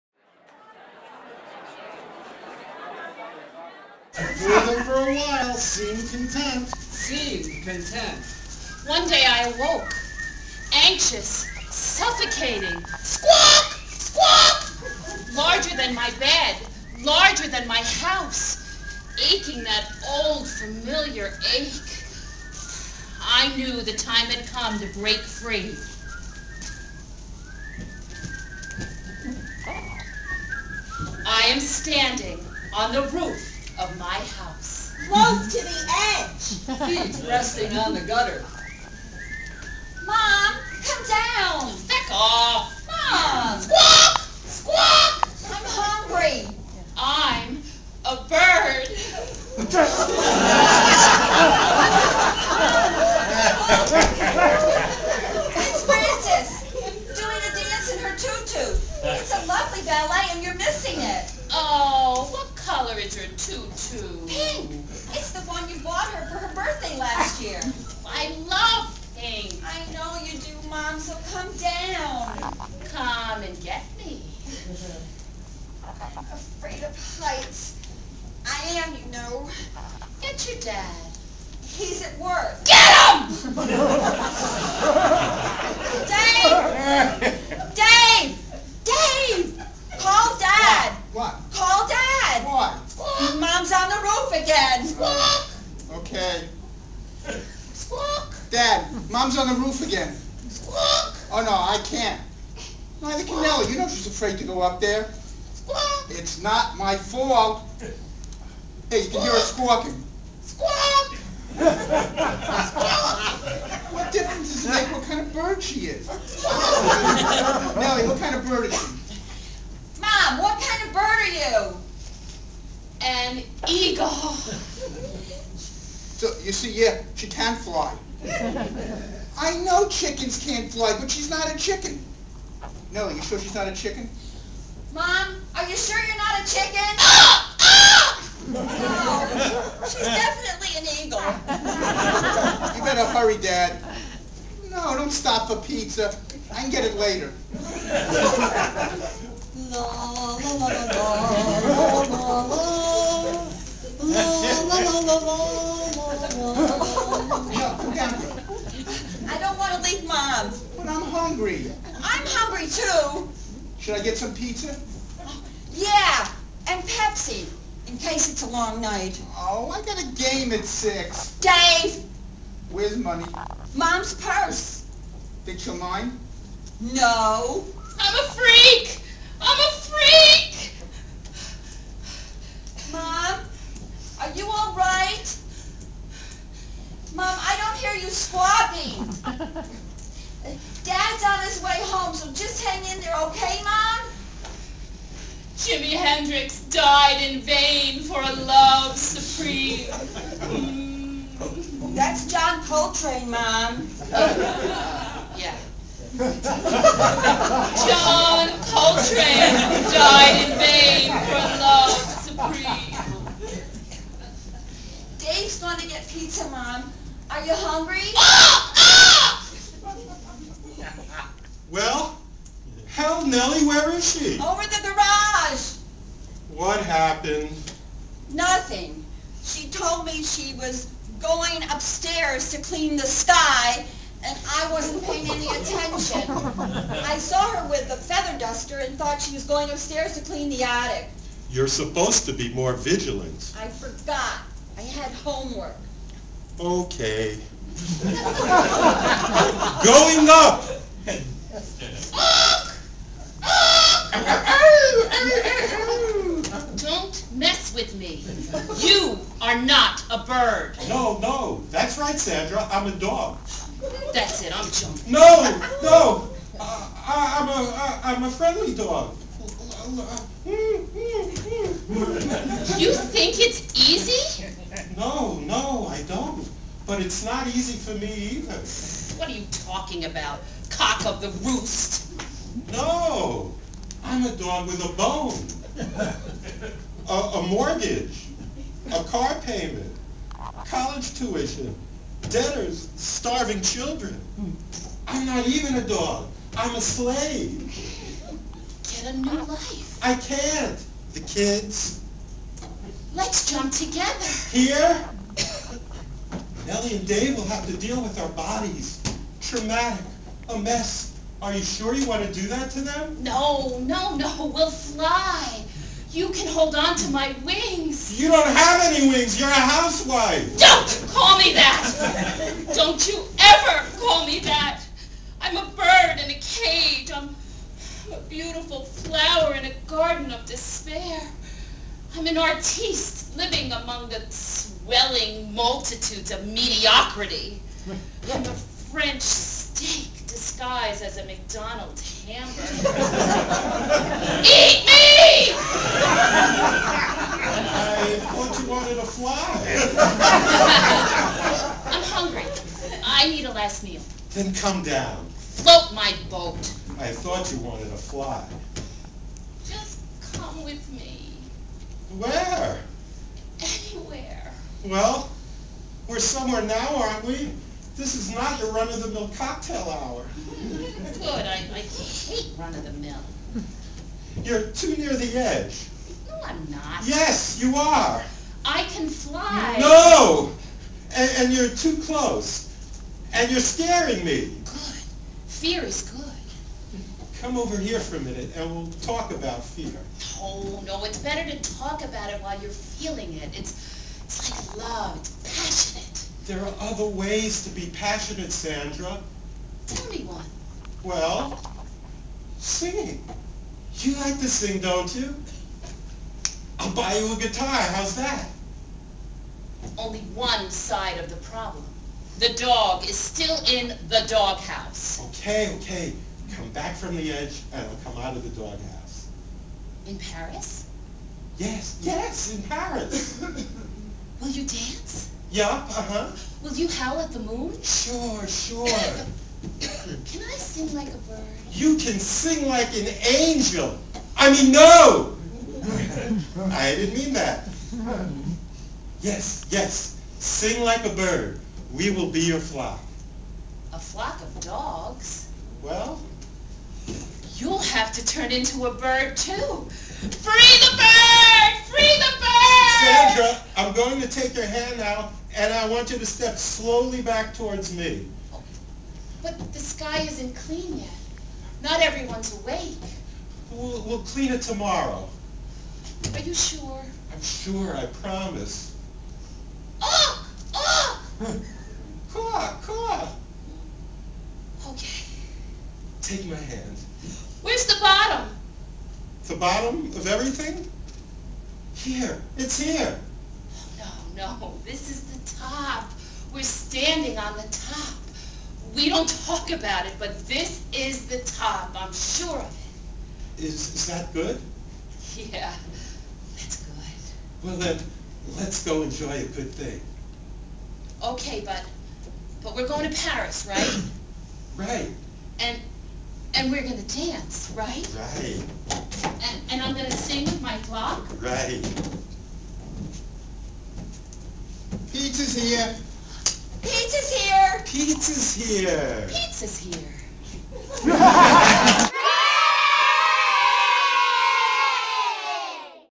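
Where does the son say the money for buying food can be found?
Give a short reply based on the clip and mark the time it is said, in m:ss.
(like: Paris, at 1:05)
Mom's purse, at 2:53.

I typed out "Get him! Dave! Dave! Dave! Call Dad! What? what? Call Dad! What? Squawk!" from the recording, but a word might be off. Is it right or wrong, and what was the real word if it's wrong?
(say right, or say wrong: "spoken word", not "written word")
right.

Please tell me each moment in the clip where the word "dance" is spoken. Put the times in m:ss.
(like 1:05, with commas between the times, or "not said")
7:04, 8:27.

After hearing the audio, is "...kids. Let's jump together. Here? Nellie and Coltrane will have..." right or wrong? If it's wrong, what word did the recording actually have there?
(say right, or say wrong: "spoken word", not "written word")
wrong: "Dave", not "Coltrane".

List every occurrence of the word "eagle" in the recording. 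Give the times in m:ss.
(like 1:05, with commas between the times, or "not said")
2:03, 2:21.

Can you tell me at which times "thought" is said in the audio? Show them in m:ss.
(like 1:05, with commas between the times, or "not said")
3:58, 5:57.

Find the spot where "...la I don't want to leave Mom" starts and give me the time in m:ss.
2:37.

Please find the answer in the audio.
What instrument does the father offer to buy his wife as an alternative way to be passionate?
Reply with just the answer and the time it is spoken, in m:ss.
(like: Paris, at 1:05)
A guitar, at 6:47.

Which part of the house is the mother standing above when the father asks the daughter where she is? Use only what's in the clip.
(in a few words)
The garage.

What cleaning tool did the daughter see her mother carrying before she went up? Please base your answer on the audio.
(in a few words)
Feather duster.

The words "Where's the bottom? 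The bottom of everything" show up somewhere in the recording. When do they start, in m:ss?
7:57.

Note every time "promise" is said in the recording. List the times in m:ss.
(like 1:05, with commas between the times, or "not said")
7:48.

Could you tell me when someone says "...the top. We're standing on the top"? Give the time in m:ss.
8:05.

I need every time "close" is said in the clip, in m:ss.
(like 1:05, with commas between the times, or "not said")
0:35, 6:22.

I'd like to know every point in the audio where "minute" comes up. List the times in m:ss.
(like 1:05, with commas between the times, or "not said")
6:28.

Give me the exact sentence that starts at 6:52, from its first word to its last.
The dog is still in the doghouse.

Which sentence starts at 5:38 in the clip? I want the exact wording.
I'm a French steak disguised as a McDonald's hamburger.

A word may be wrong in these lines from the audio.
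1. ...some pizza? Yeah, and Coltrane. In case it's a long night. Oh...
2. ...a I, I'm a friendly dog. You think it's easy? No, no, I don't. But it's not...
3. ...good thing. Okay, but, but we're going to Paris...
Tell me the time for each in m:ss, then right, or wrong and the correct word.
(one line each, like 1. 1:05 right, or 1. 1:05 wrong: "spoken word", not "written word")
1. 2:44 wrong: "Pepsi", not "Coltrane"
2. 4:27 right
3. 8:19 right.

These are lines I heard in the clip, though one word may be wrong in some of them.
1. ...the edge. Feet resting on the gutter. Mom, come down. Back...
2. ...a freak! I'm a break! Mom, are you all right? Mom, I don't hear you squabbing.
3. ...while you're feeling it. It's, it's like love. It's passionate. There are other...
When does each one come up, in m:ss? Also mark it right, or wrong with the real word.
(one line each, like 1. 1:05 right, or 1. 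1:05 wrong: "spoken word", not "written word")
1. 0:35 right
2. 2:58 wrong: "freak", not "break"
3. 6:32 right.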